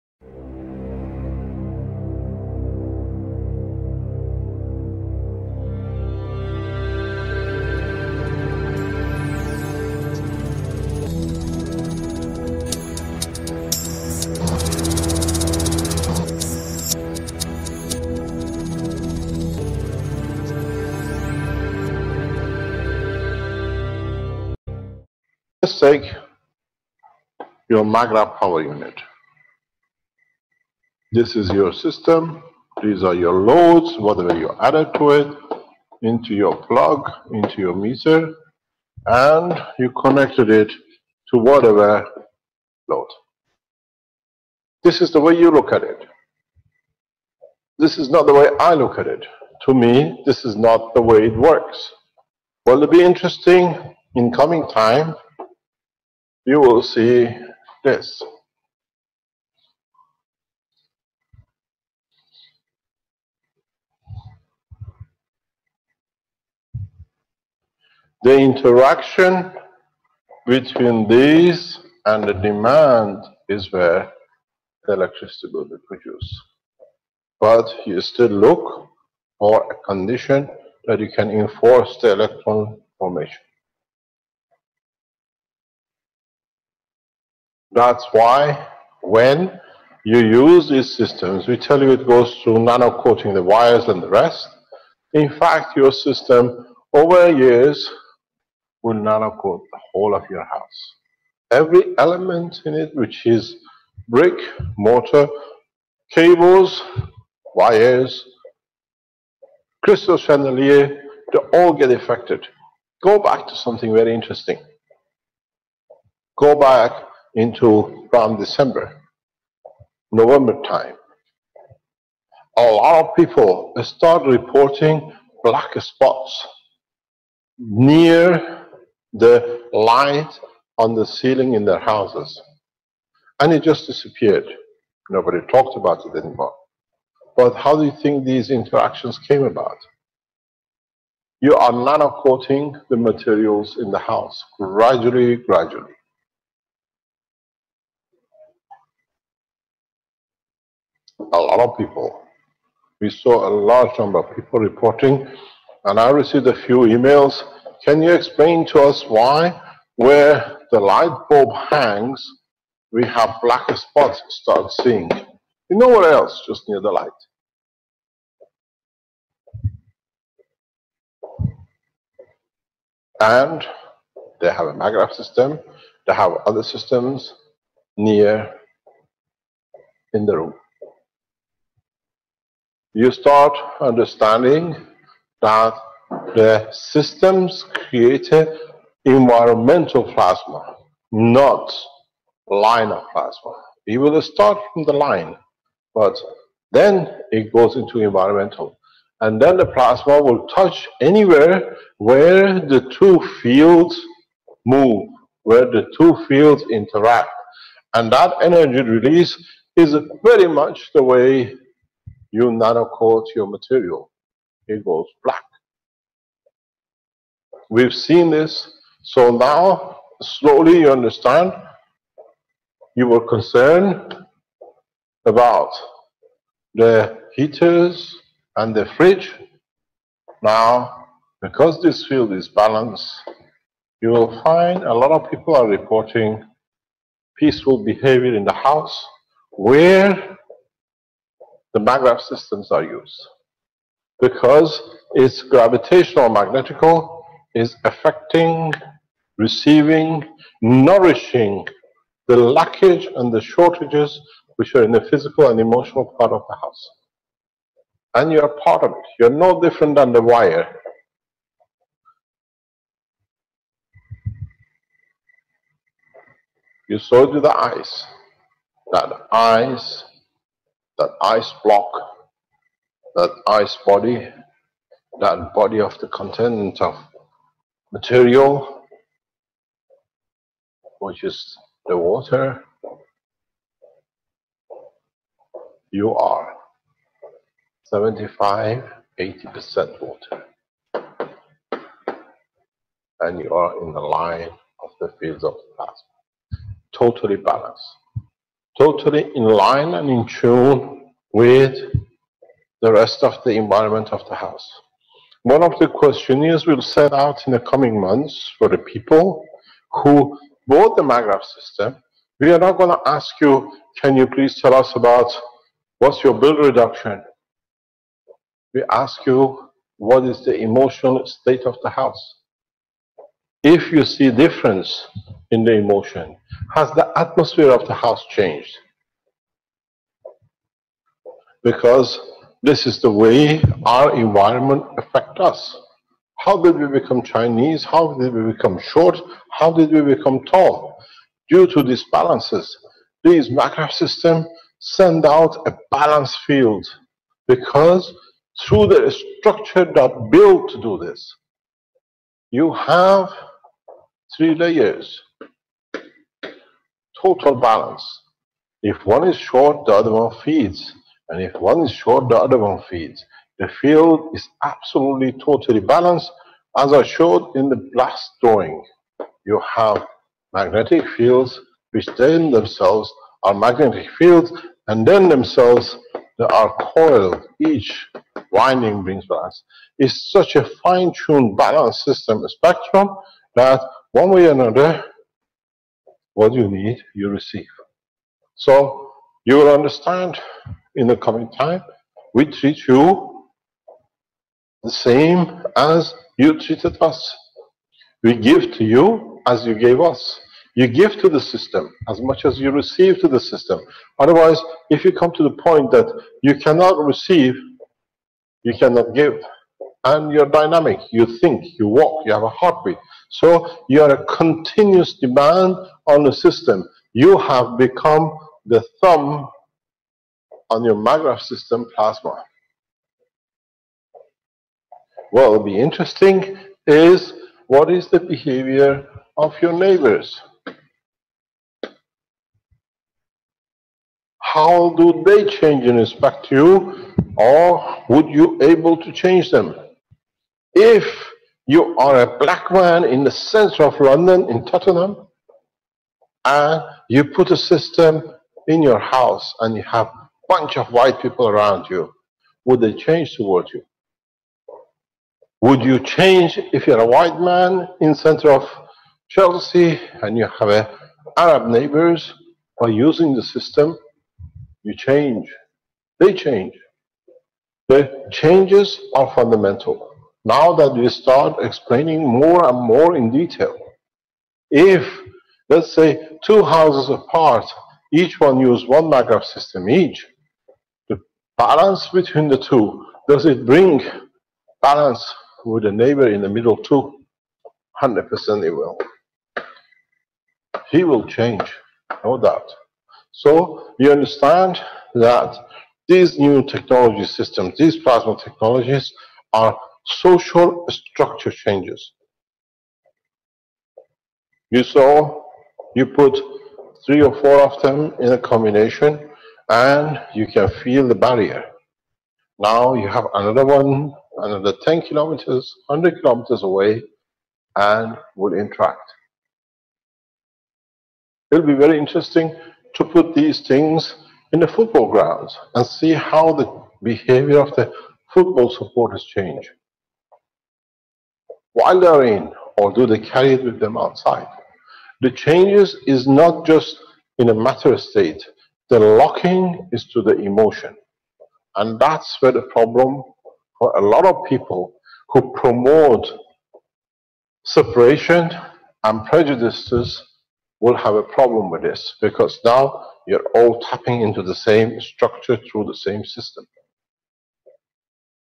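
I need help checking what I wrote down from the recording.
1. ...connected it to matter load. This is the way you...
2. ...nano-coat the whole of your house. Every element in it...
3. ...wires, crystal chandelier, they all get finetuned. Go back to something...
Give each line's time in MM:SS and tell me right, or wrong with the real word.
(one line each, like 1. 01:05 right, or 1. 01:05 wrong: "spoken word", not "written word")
1. 00:40 wrong: "whatever", not "matter"
2. 01:38 right
3. 01:47 wrong: "affected", not "finetuned".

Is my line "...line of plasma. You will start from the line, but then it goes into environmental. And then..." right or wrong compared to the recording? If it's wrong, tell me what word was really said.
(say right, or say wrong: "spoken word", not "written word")
right.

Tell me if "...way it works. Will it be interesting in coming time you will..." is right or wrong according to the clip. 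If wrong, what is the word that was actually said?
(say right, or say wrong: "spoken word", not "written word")
right.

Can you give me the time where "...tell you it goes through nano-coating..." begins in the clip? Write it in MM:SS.
01:31.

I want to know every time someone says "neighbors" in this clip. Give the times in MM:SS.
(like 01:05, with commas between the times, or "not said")
07:09, 07:41, 08:05.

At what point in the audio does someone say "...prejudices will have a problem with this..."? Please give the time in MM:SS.
09:09.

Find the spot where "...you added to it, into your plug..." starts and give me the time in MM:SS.
00:34.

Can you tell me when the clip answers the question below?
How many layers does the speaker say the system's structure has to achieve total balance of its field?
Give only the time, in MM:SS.
05:54.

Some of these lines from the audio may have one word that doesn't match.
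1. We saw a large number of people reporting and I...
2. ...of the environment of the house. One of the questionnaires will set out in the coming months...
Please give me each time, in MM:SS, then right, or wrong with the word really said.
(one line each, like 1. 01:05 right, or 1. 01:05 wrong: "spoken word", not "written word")
1. 02:32 right
2. 05:03 right.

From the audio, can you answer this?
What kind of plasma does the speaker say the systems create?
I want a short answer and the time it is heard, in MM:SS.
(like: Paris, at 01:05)
Environmental plasma, at 03:09.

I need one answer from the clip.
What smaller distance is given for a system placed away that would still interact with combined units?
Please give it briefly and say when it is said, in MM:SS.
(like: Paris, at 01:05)
10 kilometers, at 08:34.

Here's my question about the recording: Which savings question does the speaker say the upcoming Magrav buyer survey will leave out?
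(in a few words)
Bill reduction.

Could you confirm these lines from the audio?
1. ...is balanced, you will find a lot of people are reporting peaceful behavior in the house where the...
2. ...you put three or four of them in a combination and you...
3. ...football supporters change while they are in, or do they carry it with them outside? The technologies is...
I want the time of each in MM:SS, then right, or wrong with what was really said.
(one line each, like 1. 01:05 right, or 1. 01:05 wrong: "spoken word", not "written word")
1. 03:52 right
2. 08:25 right
3. 08:48 wrong: "changes", not "technologies".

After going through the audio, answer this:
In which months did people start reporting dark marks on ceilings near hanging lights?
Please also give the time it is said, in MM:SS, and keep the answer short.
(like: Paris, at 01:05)
December, November, at 01:58.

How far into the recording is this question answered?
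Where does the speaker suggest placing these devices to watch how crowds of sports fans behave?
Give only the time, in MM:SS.
08:44.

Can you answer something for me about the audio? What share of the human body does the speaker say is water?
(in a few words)
75-80%.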